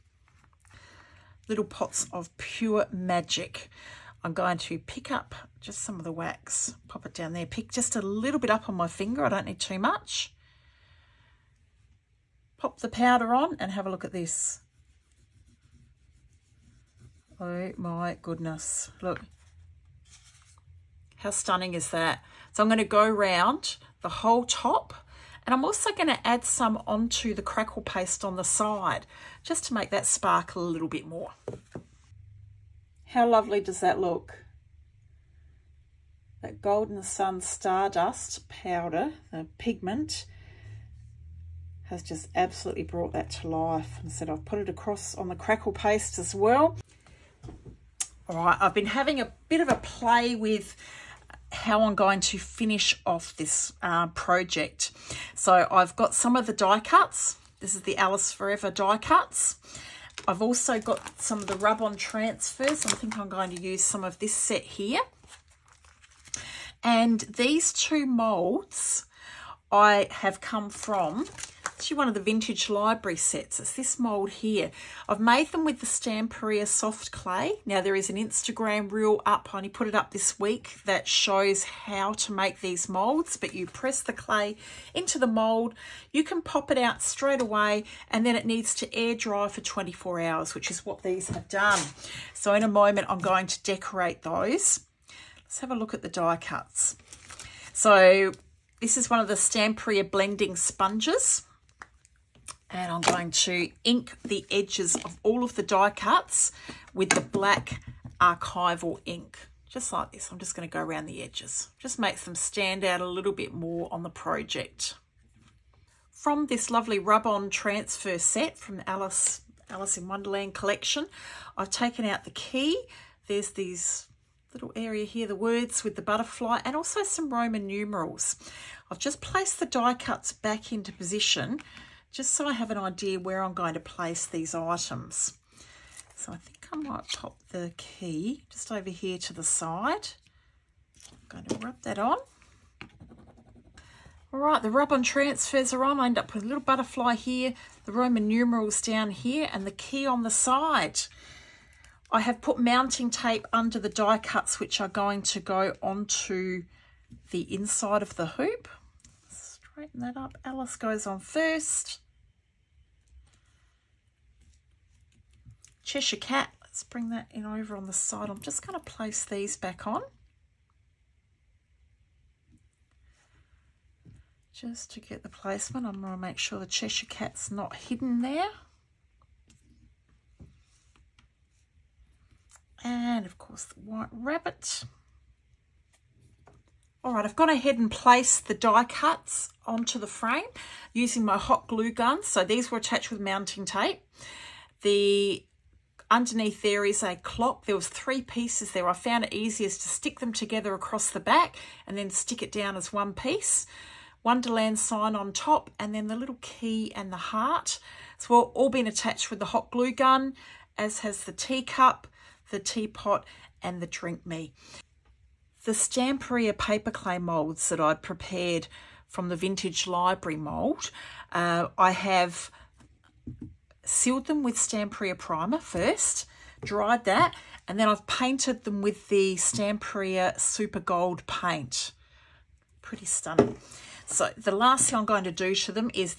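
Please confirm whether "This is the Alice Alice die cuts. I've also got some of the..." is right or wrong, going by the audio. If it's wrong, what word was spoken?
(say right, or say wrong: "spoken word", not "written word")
wrong: "Forever", not "Alice".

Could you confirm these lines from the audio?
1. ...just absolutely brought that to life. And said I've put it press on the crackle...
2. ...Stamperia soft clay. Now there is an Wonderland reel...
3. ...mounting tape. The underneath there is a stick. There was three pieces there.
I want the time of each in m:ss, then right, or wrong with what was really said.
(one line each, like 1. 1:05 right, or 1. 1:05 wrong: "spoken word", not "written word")
1. 0:42 wrong: "across", not "press"
2. 1:15 wrong: "Instagram", not "Wonderland"
3. 3:13 wrong: "clock", not "stick".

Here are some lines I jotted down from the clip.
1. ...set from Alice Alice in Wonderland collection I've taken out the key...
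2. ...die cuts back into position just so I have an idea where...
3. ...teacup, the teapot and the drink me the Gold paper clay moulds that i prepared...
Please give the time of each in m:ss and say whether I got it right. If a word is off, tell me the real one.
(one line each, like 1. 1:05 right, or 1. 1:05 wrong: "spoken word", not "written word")
1. 1:58 right
2. 2:09 right
3. 3:31 wrong: "Stamperia", not "Gold".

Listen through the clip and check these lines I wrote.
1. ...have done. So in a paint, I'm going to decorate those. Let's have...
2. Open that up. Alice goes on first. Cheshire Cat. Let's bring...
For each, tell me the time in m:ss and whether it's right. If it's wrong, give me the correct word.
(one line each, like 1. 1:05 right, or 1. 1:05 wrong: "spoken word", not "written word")
1. 1:31 wrong: "moment", not "paint"
2. 2:39 right.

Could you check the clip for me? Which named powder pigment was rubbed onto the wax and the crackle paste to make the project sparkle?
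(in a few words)
golden sun stardust.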